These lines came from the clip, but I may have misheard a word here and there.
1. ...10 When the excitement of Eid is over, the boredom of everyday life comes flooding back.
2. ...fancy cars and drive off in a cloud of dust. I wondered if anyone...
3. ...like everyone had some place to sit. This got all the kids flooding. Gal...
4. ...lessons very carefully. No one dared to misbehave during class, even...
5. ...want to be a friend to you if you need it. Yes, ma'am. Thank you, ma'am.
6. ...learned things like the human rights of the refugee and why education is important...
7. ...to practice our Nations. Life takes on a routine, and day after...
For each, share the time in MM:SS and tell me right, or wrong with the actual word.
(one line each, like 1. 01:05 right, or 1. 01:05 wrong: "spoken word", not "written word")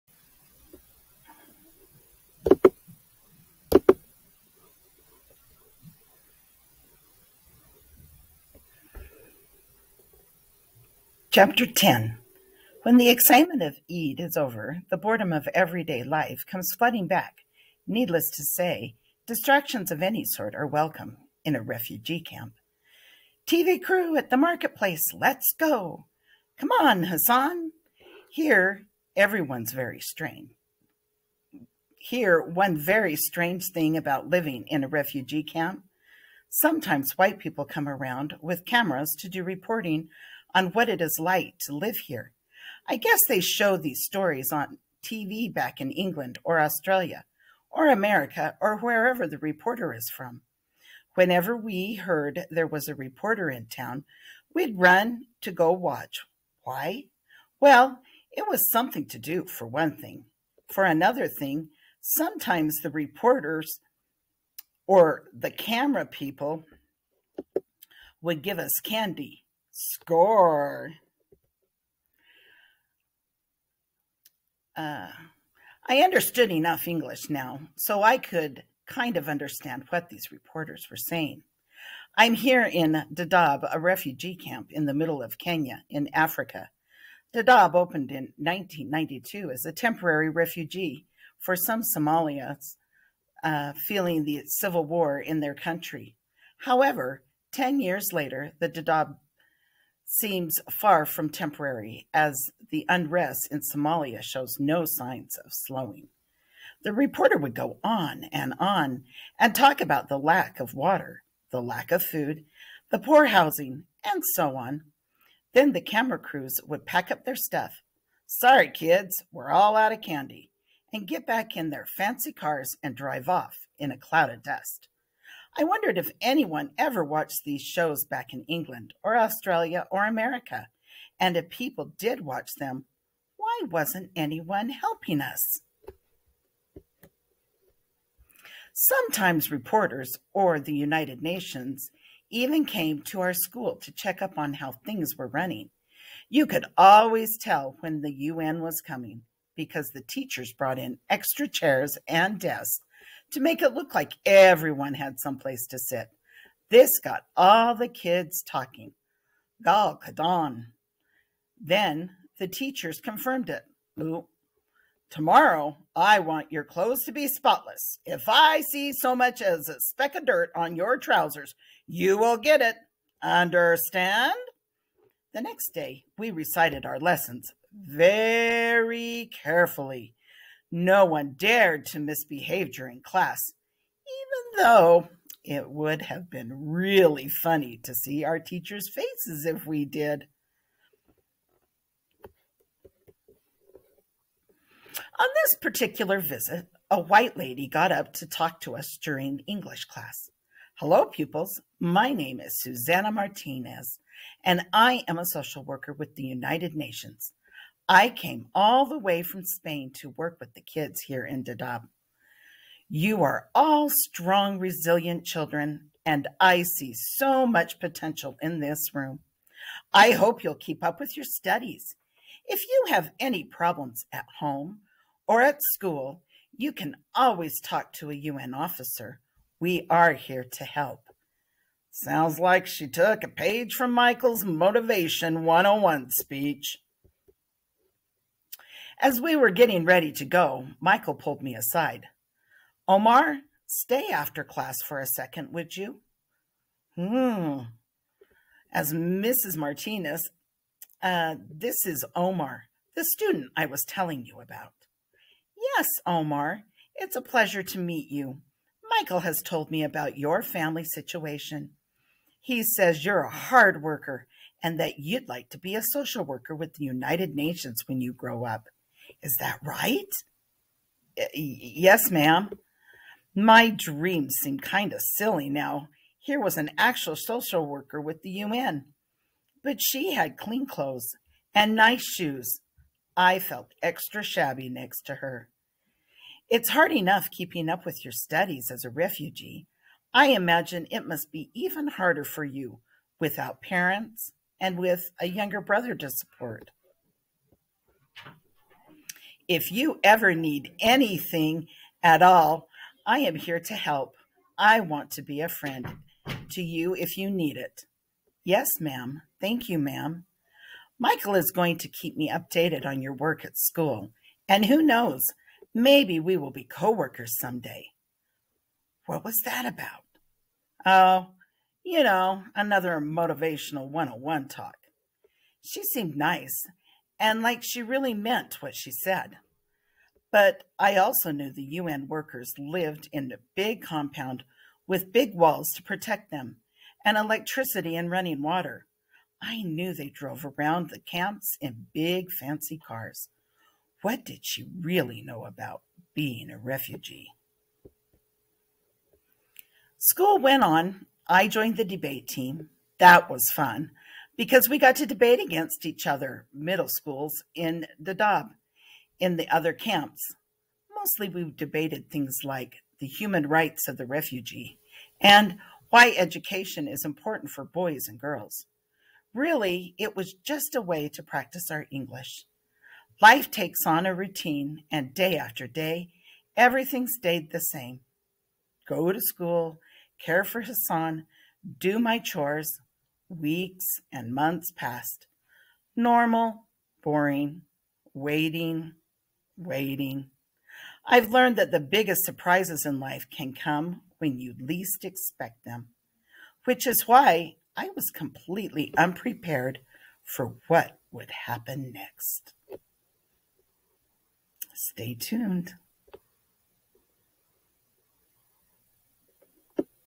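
1. 00:11 right
2. 02:01 right
3. 02:33 wrong: "talking", not "flooding"
4. 02:56 right
5. 05:04 right
6. 06:01 wrong: "debated", not "learned"
7. 06:11 wrong: "English", not "Nations".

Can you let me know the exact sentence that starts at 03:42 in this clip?
If you have any problems at home or at school, you can always talk to a UN officer.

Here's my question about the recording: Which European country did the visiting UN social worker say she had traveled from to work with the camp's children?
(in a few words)
Spain.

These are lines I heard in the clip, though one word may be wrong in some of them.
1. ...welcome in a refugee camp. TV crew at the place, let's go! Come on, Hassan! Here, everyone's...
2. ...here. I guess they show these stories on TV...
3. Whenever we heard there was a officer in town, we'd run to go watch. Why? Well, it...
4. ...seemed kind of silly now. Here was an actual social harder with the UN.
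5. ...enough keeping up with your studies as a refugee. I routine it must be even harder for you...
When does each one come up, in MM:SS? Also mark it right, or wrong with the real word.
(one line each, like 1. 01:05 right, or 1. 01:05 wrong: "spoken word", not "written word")
1. 00:20 wrong: "marketplace", not "place"
2. 00:42 right
3. 00:51 wrong: "reporter", not "officer"
4. 04:34 wrong: "worker", not "harder"
5. 04:46 wrong: "imagine", not "routine".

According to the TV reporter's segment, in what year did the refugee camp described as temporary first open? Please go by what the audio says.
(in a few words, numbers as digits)
1992.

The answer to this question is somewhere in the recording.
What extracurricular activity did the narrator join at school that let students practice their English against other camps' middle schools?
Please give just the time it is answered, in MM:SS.
05:51.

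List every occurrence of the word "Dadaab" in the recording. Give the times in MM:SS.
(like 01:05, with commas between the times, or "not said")
01:23, 01:27, 01:38, 03:31, 05:58.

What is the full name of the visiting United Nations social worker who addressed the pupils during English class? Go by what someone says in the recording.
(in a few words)
Susanna Martinez.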